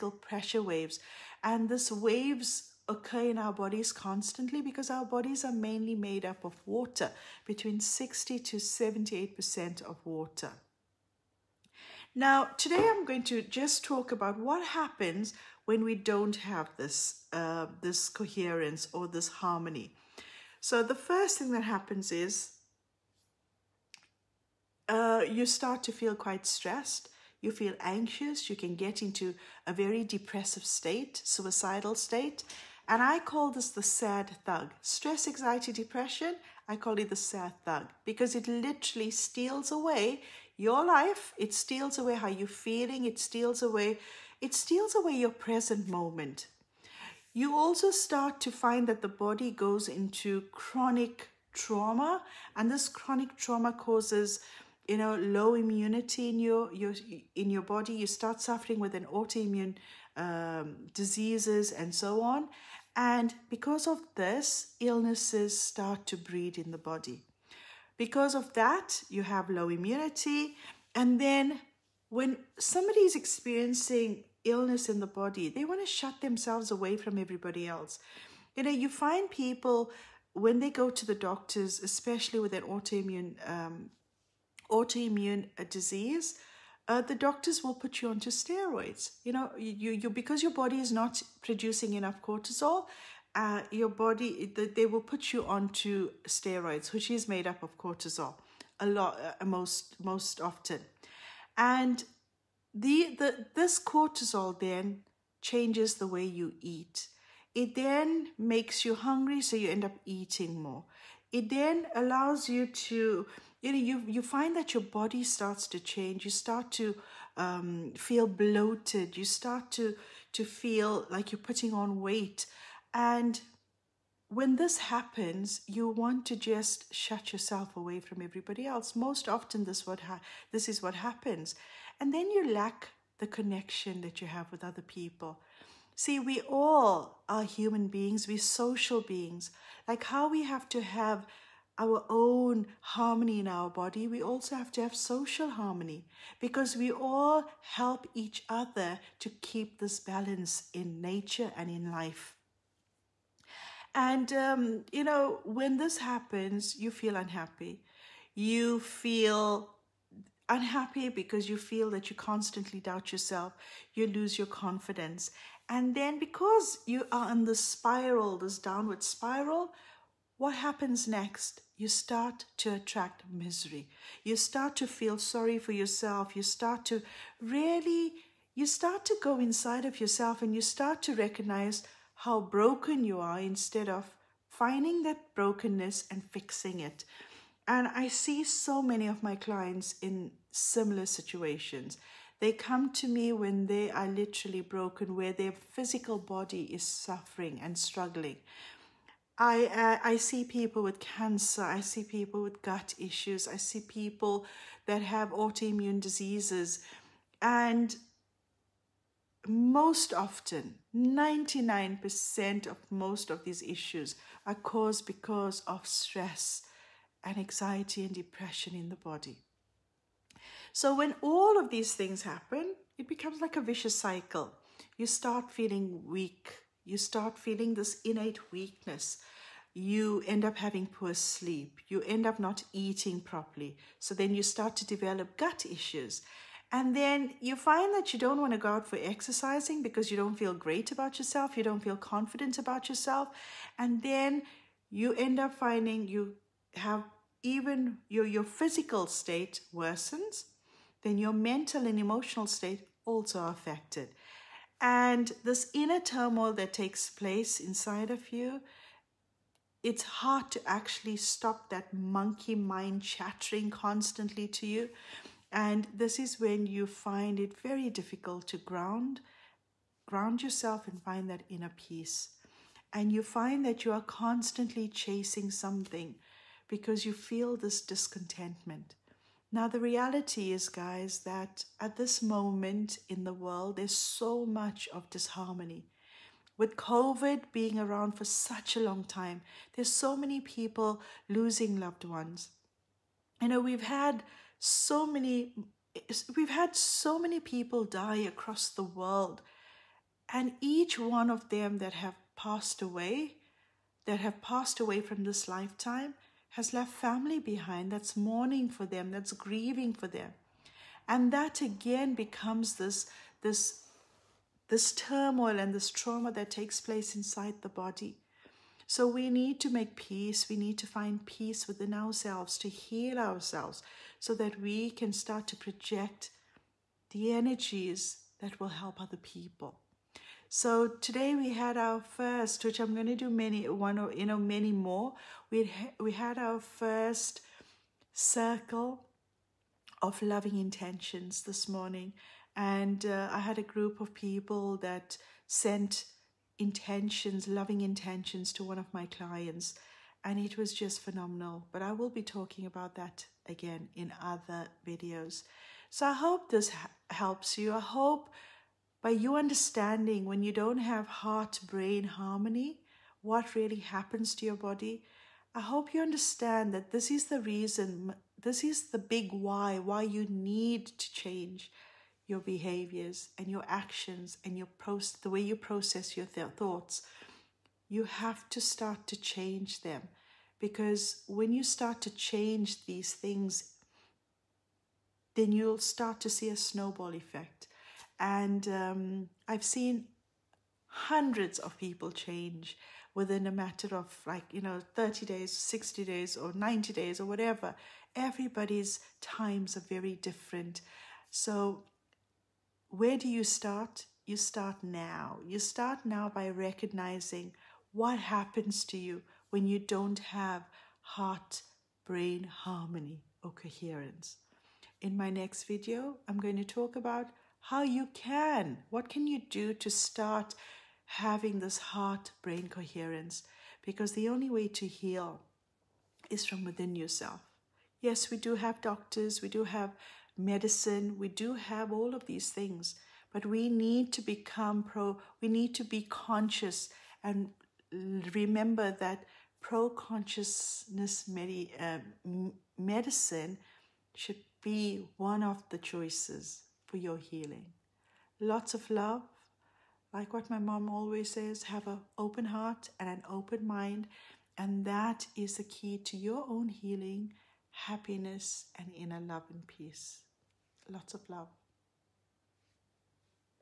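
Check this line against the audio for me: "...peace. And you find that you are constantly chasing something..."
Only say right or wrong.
right.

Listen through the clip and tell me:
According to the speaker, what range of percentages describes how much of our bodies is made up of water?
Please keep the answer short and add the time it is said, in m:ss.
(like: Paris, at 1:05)
60 to 78%, at 0:07.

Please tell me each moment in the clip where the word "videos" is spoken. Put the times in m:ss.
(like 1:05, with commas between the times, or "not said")
5:54, 6:55.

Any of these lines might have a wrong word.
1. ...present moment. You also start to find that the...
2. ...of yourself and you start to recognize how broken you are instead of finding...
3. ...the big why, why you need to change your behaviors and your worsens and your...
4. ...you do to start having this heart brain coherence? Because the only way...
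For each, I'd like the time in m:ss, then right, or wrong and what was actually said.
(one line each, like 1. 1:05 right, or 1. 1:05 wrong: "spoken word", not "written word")
1. 0:45 right
2. 2:59 right
3. 6:08 wrong: "actions", not "worsens"
4. 6:59 right.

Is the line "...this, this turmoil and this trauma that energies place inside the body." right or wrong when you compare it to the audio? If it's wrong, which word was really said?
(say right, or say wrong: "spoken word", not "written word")
wrong: "takes", not "energies".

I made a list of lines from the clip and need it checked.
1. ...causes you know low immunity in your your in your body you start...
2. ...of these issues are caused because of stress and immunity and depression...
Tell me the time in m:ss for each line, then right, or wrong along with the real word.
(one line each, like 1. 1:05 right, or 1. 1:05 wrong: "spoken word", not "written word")
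1. 0:53 right
2. 3:33 wrong: "anxiety", not "immunity".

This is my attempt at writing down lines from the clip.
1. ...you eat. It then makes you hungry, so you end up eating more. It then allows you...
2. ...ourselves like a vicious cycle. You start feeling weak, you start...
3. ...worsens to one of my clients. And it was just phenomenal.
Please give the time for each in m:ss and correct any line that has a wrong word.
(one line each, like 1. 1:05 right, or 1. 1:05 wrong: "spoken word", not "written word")
1. 1:46 right
2. 3:43 wrong: "becomes", not "ourselves"
3. 5:47 wrong: "intentions", not "worsens".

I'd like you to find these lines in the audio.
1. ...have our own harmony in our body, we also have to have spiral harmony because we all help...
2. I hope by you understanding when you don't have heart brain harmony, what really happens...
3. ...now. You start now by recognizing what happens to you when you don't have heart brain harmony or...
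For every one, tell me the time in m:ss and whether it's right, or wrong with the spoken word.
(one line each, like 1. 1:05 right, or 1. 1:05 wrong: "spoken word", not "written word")
1. 2:20 wrong: "social", not "spiral"
2. 5:57 right
3. 6:44 right.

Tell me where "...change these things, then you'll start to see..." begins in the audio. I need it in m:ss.
6:22.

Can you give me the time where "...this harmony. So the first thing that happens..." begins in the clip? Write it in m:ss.
0:19.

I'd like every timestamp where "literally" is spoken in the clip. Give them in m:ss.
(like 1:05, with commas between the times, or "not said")
0:38, 3:14.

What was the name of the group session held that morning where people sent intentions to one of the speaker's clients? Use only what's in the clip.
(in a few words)
circle of loving intentions.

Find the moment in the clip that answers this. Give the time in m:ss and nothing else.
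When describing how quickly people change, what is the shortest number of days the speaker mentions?
6:34.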